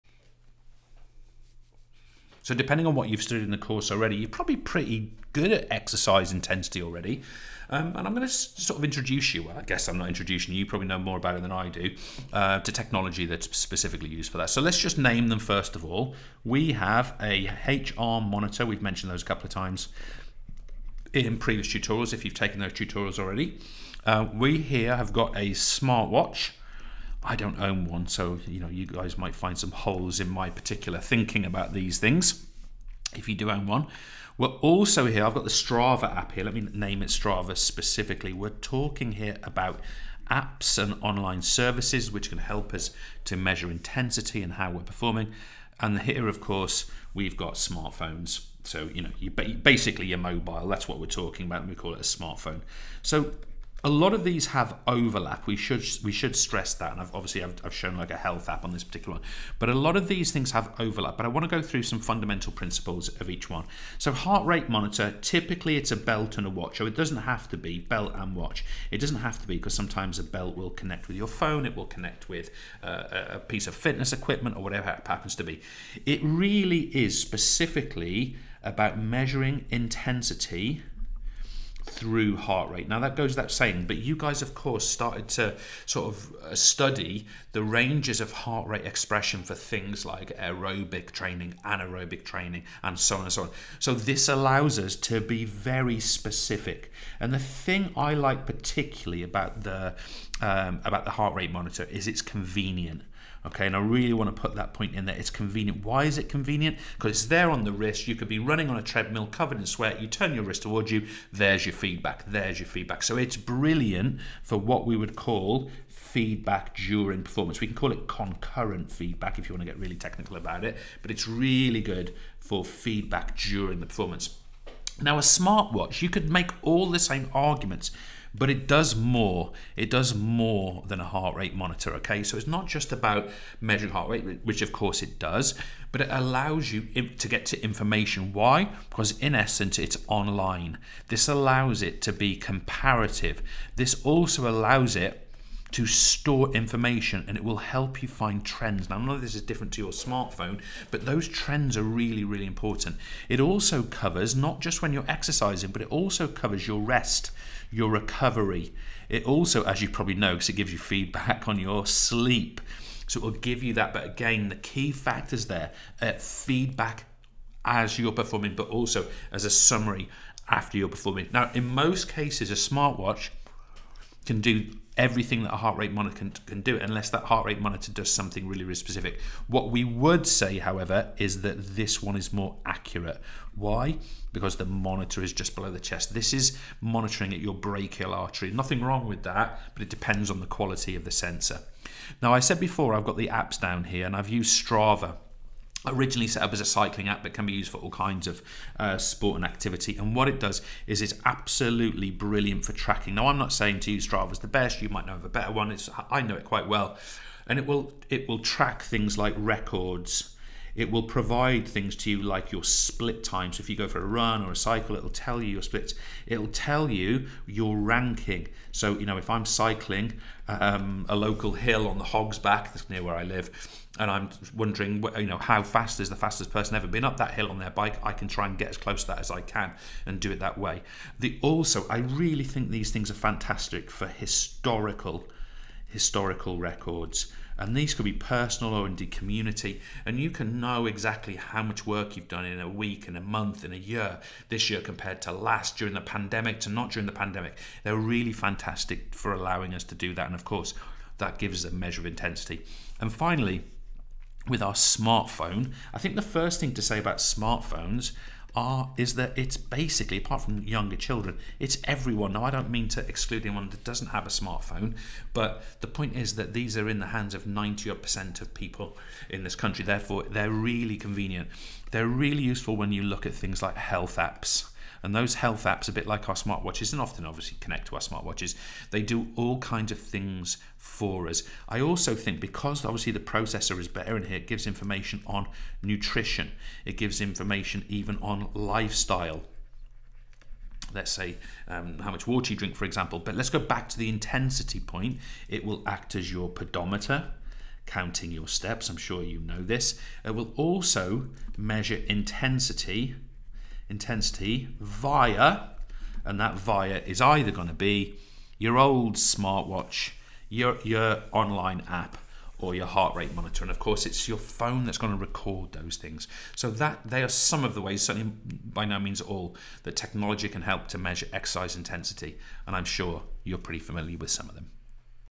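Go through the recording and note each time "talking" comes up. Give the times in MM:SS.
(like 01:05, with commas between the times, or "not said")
00:38, 00:51.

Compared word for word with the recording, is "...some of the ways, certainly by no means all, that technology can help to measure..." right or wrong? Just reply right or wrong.
right.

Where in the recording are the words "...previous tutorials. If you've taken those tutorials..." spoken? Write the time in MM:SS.
00:21.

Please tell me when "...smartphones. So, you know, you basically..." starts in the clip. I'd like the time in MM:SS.
00:47.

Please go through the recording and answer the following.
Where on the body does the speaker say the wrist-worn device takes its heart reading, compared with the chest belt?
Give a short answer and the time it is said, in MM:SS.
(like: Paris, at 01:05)
brachial artery, at 03:07.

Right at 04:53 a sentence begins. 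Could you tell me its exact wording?
But let's go back to the intensity point.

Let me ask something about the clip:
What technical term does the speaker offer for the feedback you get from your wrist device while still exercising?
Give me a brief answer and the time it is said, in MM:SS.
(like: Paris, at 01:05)
concurrent feedback, at 01:58.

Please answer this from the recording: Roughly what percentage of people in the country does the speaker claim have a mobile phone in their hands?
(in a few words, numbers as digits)
90 percent.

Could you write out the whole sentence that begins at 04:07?
They're really fantastic for allowing us to do that.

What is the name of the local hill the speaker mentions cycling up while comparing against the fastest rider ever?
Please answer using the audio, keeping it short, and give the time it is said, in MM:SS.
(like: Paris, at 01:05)
Hog's Back, at 03:42.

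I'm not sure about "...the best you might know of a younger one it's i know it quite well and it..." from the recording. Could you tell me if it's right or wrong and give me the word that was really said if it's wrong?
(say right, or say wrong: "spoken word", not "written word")
wrong: "better", not "younger".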